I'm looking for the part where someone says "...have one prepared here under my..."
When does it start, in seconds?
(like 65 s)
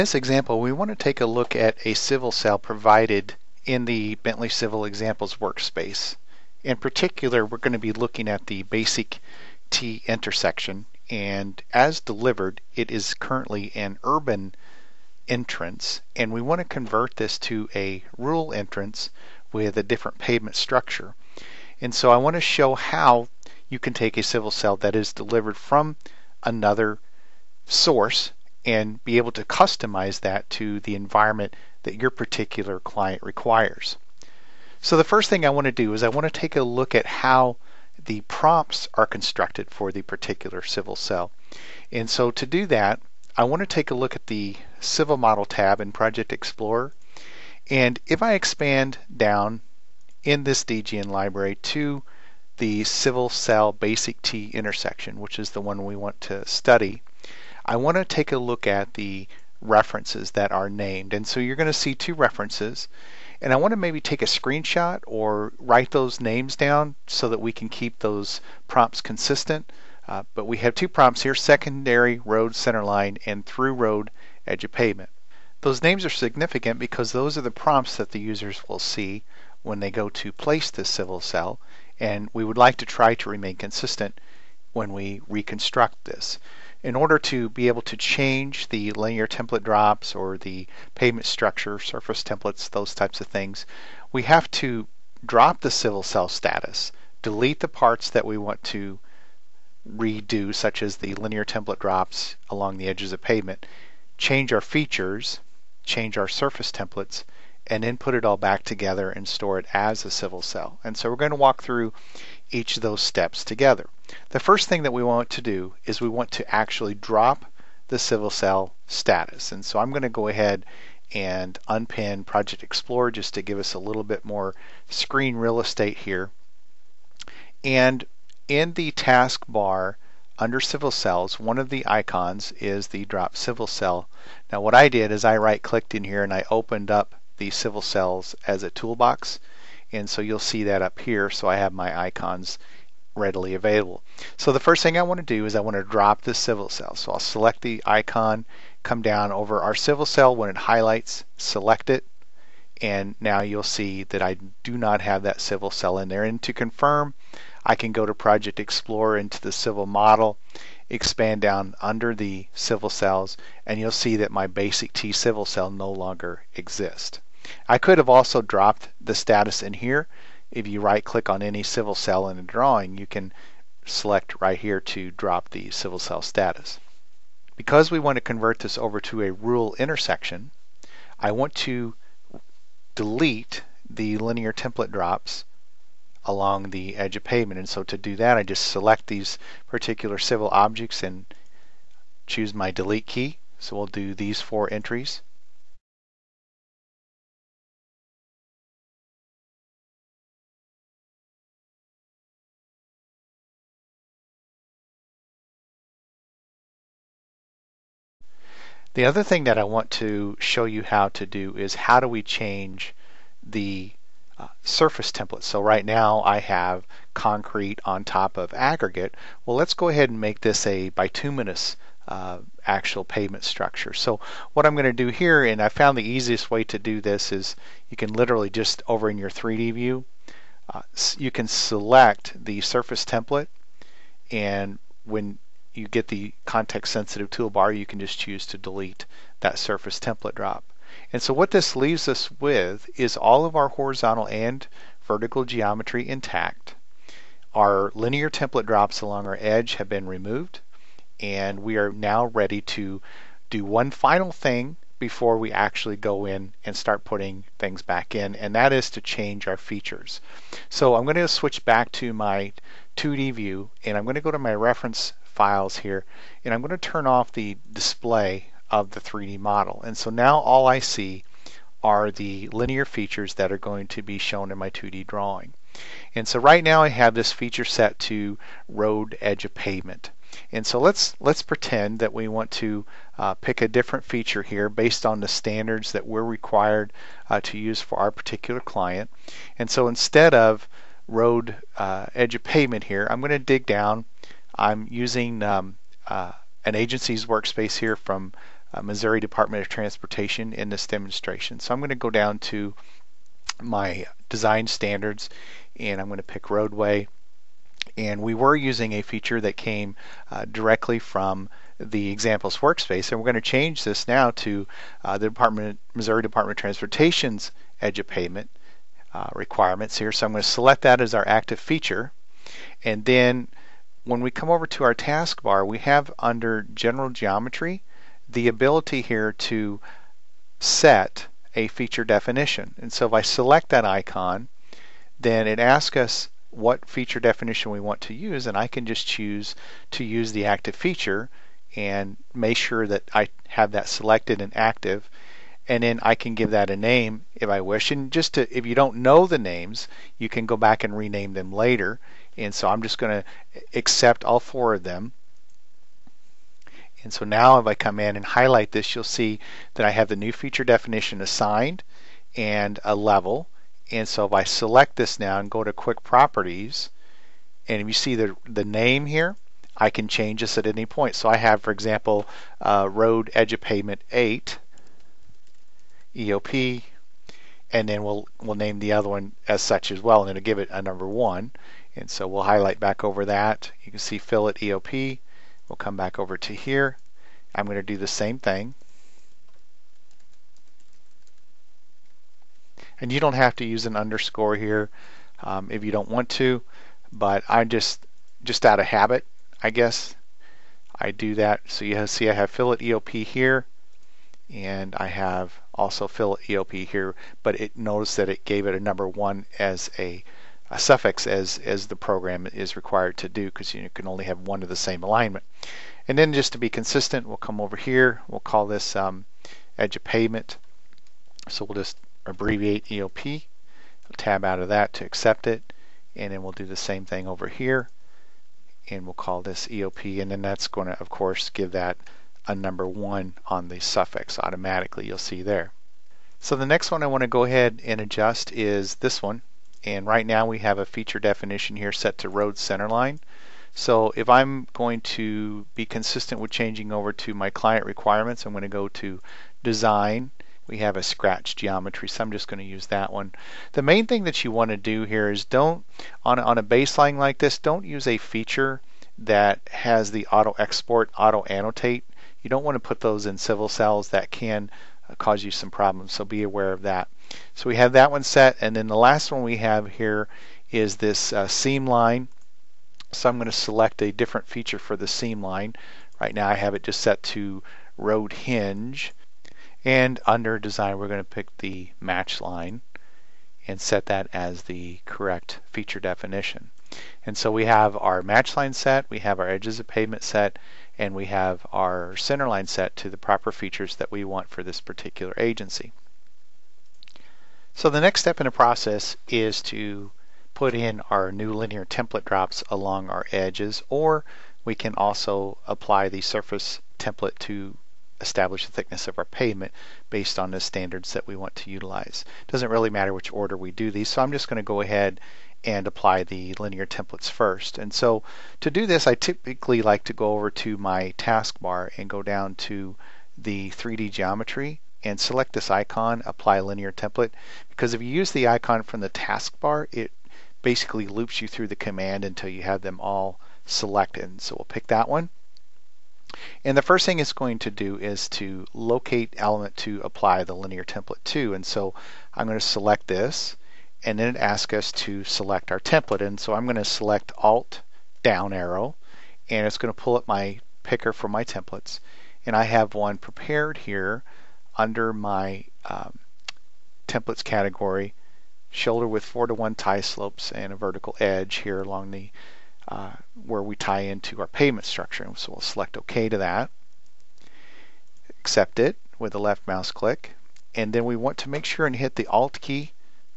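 552 s.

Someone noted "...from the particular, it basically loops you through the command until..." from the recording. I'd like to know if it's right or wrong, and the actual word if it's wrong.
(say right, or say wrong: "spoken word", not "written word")
wrong: "taskbar", not "particular".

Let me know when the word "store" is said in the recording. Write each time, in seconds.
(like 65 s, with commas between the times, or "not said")
109 s.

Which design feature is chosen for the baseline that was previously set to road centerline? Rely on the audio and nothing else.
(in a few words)
scratch geometry.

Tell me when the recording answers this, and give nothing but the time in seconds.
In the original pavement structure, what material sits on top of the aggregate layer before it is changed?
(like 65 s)
217 s.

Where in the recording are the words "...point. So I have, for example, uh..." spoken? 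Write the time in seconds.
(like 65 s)
370 s.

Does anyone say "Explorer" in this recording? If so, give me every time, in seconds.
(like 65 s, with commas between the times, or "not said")
46 s, 122 s, 158 s.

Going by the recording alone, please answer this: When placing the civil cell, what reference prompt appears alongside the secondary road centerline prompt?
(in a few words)
through road edge of pavement.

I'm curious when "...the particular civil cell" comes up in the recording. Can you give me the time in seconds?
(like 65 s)
39 s.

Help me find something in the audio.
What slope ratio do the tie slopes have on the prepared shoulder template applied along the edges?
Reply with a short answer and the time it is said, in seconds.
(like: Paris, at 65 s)
4 to 1, at 559 s.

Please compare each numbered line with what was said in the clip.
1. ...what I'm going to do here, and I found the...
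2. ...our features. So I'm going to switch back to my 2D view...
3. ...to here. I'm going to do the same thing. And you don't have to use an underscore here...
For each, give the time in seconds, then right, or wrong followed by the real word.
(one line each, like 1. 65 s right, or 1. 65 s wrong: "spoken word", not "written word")
1. 224 s right
2. 259 s right
3. 386 s right.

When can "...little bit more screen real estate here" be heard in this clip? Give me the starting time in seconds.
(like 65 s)
123 s.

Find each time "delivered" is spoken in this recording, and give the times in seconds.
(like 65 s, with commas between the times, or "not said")
11 s, 25 s.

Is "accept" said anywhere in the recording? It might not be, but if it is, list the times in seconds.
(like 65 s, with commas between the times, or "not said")
353 s, 425 s, 568 s.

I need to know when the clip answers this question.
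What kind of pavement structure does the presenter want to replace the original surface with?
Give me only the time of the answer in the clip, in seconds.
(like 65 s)
220 s.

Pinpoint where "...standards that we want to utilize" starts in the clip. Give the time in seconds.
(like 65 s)
510 s.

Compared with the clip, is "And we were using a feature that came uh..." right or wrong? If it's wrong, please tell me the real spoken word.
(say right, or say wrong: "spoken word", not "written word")
right.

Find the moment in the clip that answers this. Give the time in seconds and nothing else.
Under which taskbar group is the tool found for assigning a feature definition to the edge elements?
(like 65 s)
326 s.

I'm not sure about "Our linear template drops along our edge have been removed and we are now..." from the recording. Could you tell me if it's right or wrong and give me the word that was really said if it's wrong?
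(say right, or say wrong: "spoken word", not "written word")
right.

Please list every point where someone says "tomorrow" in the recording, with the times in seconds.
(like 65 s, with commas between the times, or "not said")
not said.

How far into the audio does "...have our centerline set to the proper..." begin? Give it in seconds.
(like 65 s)
491 s.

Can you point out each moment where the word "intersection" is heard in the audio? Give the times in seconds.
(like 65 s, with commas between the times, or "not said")
10 s, 54 s, 179 s.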